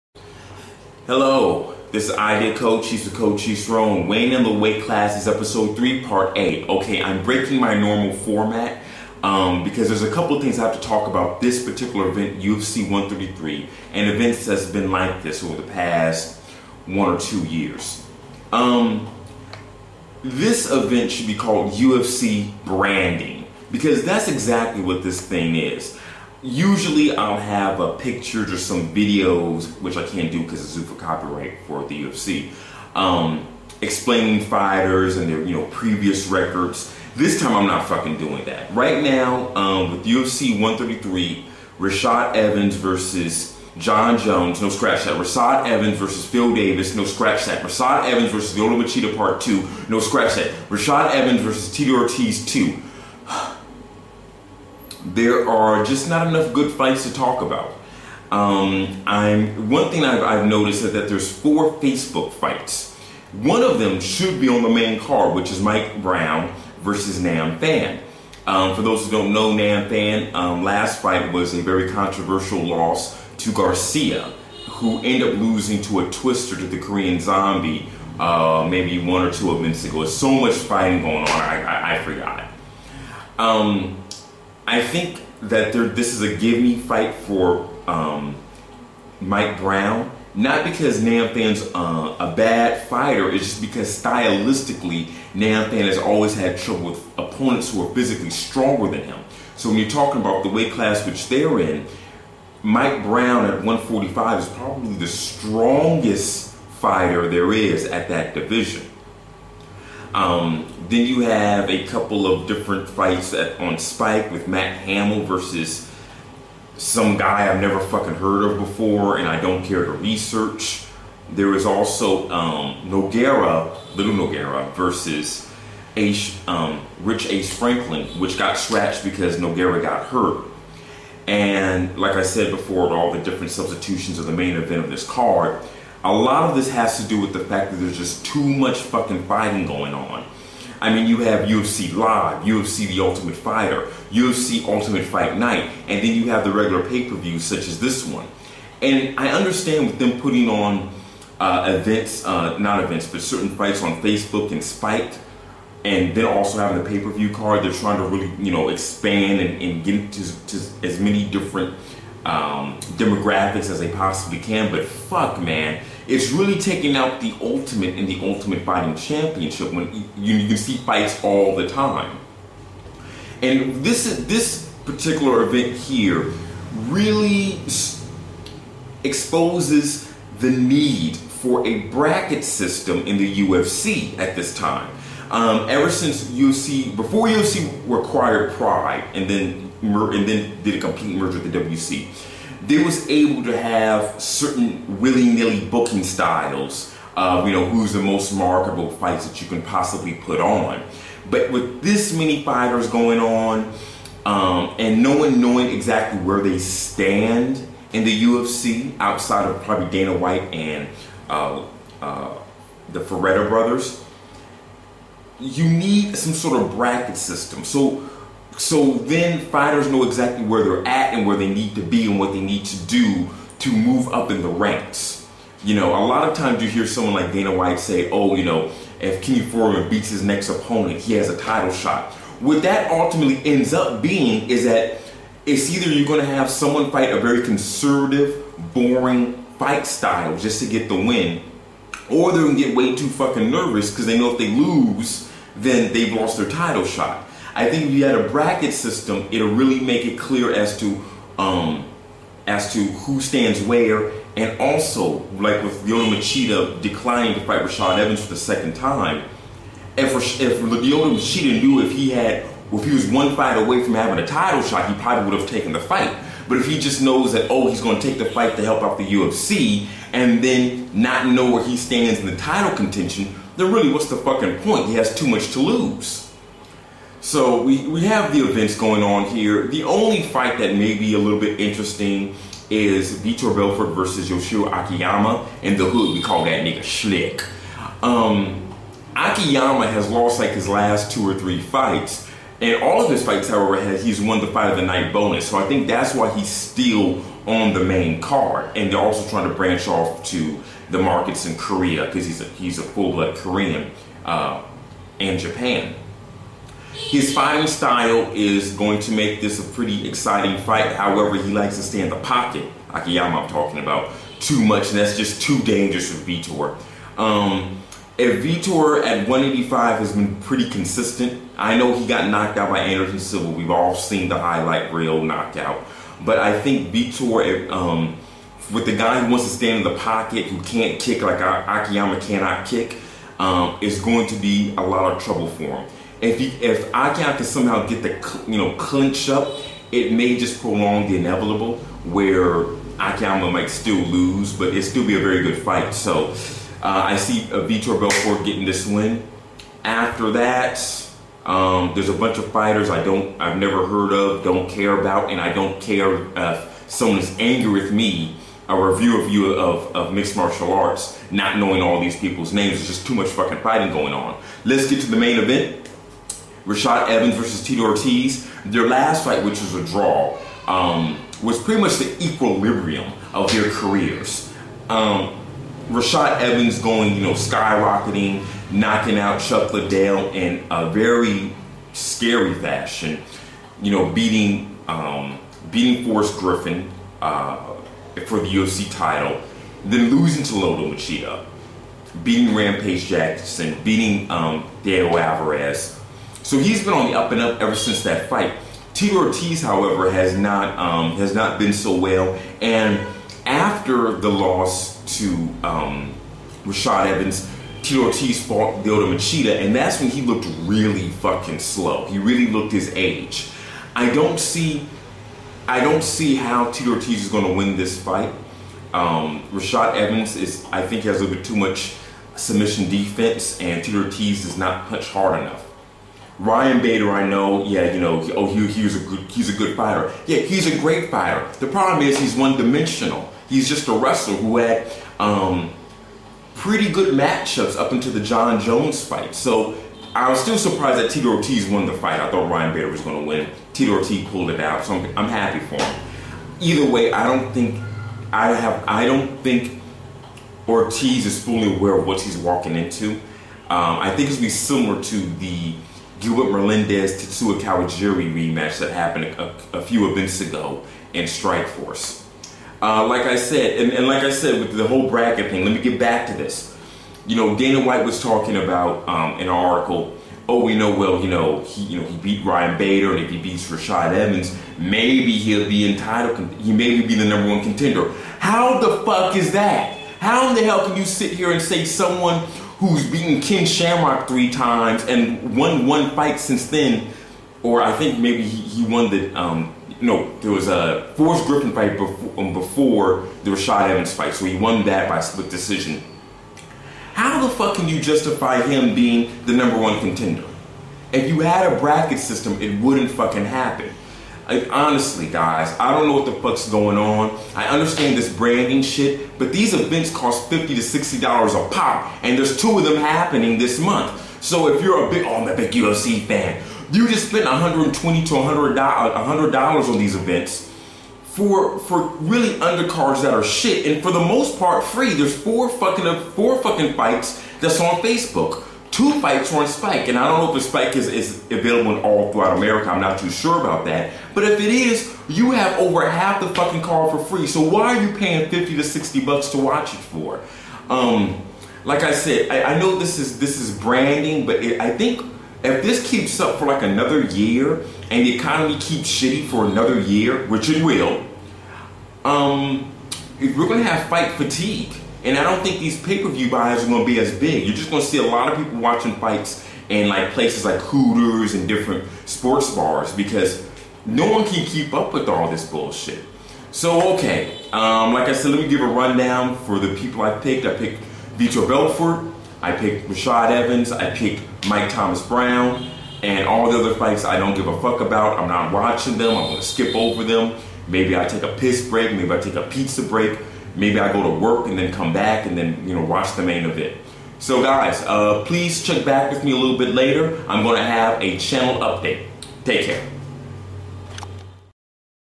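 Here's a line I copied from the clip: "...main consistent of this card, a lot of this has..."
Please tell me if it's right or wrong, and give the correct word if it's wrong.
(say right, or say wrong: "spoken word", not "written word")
wrong: "event", not "consistent".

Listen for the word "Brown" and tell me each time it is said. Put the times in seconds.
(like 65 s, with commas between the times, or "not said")
66 s, 89 s, 103 s, 575 s.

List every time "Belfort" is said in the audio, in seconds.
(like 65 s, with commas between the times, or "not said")
283 s, 347 s, 571 s.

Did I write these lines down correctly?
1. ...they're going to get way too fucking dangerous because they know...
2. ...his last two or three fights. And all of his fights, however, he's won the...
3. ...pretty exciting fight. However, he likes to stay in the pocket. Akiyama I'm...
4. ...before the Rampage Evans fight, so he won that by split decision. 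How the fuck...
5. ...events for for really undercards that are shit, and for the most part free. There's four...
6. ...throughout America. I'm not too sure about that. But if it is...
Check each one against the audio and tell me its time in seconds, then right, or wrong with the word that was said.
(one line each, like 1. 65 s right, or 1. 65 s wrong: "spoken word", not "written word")
1. 242 s wrong: "nervous", not "dangerous"
2. 290 s right
3. 309 s right
4. 492 s wrong: "Rashad", not "Rampage"
5. 520 s right
6. 532 s right.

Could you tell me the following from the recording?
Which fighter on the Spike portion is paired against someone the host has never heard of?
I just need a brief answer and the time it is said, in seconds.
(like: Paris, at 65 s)
Matt Hamill, at 114 s.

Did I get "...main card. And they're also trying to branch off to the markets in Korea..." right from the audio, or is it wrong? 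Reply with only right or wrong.
right.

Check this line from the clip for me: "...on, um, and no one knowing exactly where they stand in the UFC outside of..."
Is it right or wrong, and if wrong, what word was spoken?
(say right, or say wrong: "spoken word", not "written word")
right.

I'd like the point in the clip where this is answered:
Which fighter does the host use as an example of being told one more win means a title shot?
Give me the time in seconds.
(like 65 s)
229 s.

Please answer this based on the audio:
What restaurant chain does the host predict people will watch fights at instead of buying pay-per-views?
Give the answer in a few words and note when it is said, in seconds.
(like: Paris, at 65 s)
Hooters, at 560 s.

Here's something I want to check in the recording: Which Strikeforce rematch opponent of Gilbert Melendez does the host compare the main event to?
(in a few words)
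Tatsuya Kawajiri.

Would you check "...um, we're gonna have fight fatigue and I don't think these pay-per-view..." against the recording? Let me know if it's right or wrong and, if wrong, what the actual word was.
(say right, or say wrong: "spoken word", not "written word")
right.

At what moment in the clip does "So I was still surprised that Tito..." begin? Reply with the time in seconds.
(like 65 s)
439 s.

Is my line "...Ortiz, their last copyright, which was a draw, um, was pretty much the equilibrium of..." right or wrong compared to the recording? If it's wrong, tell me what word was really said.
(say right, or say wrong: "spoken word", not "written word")
wrong: "fight", not "copyright".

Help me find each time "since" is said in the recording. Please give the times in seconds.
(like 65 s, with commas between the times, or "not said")
185 s, 397 s, 486 s.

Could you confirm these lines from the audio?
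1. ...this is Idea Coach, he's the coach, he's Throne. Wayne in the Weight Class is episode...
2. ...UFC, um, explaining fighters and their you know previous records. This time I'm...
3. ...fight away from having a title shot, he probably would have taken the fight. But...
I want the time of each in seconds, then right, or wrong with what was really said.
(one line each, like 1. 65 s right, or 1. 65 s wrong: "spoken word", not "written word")
1. 1 s right
2. 32 s right
3. 263 s right.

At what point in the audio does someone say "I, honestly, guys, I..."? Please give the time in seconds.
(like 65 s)
504 s.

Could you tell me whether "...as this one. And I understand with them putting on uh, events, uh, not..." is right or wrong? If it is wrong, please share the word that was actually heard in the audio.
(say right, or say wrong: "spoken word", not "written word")
right.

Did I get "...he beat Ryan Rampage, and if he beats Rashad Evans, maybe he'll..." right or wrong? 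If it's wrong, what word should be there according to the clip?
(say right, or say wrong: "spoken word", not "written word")
wrong: "Bader", not "Rampage".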